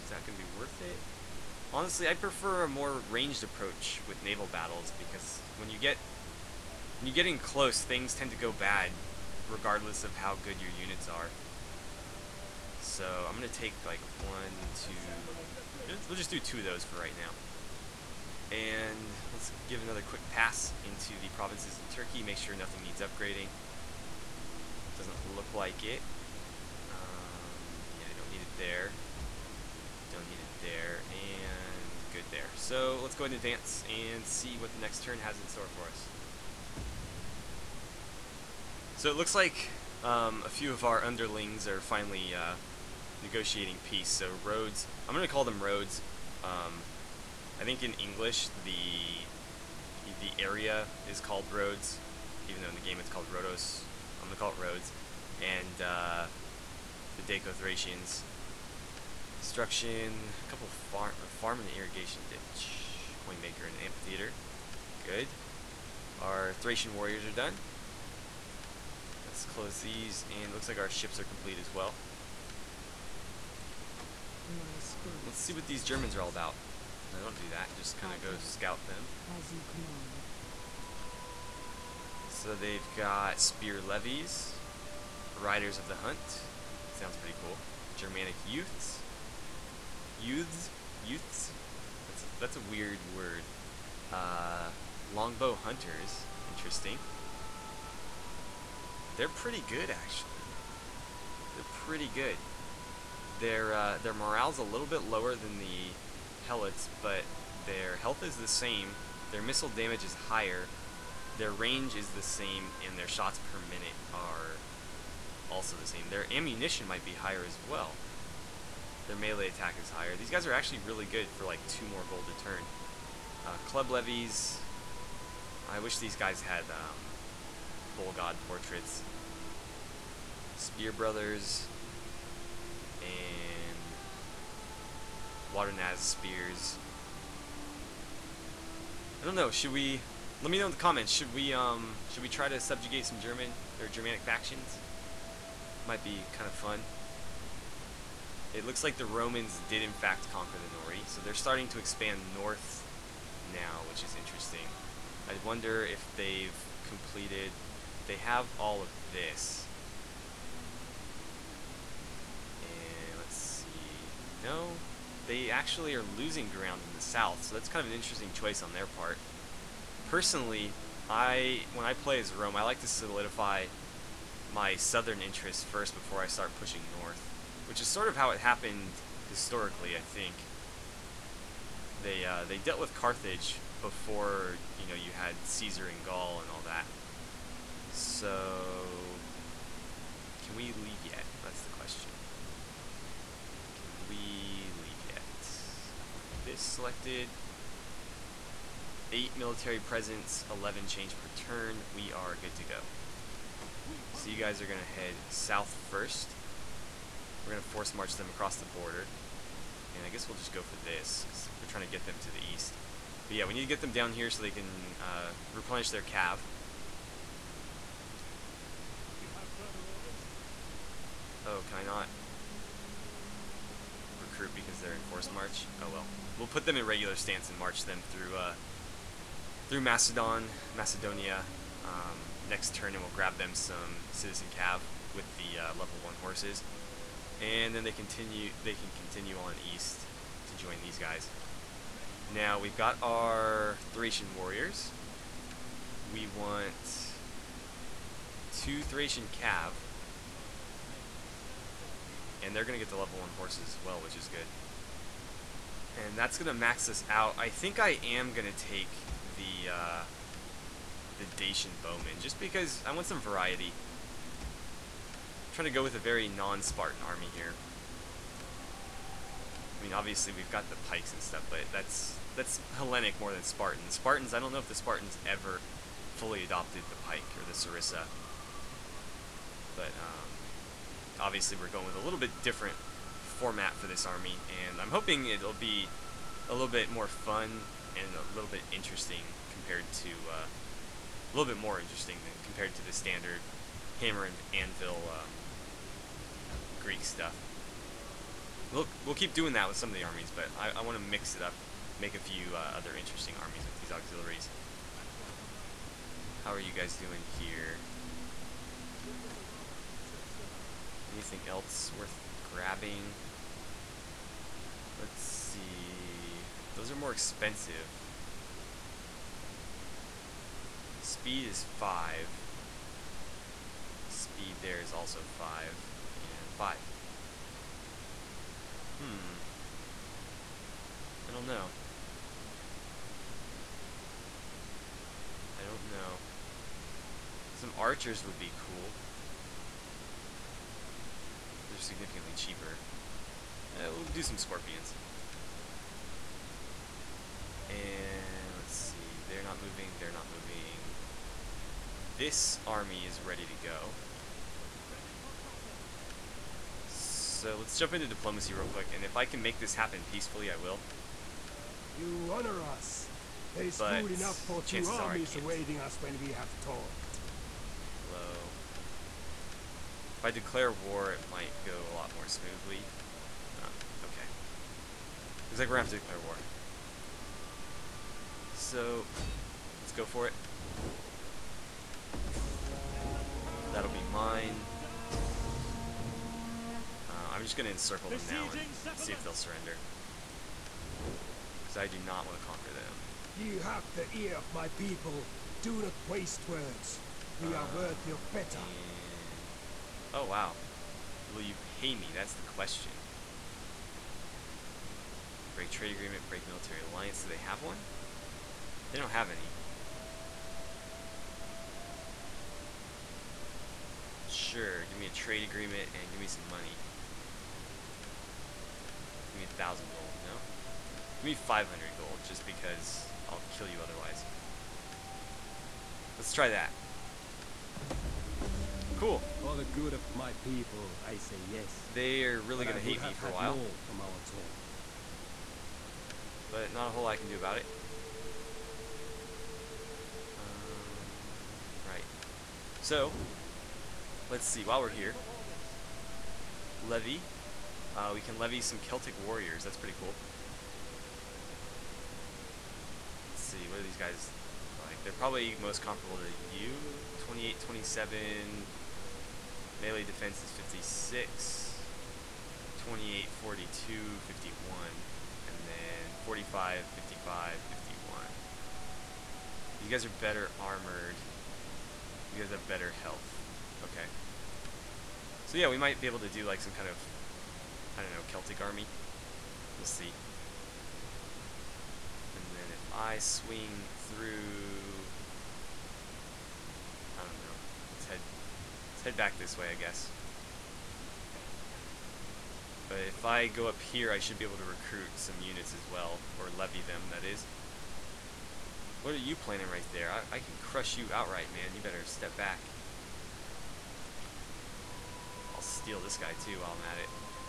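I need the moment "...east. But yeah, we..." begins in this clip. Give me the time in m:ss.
3:32.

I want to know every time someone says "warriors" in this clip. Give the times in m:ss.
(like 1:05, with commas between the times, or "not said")
1:06, 4:04, 7:29.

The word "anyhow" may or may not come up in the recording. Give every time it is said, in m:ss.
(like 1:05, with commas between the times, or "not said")
not said.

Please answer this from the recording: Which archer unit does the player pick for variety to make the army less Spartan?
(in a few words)
Dacian Bowman.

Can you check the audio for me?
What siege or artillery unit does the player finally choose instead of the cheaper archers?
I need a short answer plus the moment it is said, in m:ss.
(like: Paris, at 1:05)
Scorpions, at 5:44.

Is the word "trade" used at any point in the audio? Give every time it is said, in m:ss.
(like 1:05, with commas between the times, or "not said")
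6:45, 6:55.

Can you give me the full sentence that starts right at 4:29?
I mean, obviously we've got the pikes and stuff, but that's that's Hellenic more than Spartan.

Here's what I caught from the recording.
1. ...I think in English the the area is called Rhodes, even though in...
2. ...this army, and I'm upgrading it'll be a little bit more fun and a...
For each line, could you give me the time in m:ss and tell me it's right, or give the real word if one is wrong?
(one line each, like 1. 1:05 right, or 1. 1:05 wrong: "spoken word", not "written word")
1. 0:47 right
2. 4:43 wrong: "hoping", not "upgrading".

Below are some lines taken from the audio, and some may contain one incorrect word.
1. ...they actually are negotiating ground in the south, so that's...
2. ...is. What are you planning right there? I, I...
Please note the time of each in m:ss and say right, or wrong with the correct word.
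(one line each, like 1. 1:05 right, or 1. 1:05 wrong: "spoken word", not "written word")
1. 2:45 wrong: "losing", not "negotiating"
2. 8:17 right.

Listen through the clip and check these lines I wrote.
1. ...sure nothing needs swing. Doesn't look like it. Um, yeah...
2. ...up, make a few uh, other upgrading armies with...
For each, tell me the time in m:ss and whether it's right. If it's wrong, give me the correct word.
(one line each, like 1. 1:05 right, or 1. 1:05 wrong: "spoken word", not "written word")
1. 0:22 wrong: "upgrading", not "swing"
2. 5:01 wrong: "interesting", not "upgrading".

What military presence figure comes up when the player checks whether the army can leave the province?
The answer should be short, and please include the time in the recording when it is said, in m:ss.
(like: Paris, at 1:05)
8, at 3:19.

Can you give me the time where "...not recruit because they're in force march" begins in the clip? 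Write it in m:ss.
3:41.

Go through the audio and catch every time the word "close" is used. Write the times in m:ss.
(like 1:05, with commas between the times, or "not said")
0:07, 1:09.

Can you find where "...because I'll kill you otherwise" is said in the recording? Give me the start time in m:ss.
7:02.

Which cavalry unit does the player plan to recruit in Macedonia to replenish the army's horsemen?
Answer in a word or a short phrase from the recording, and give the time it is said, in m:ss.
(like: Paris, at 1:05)
Citizen Cav, at 3:54.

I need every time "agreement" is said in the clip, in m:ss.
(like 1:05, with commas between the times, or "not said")
6:45, 6:55.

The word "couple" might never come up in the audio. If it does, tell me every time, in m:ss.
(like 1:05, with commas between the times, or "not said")
1:00.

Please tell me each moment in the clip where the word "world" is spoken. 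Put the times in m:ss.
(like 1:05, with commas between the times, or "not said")
not said.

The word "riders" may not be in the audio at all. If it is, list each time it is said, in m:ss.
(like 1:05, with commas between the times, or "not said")
1:25.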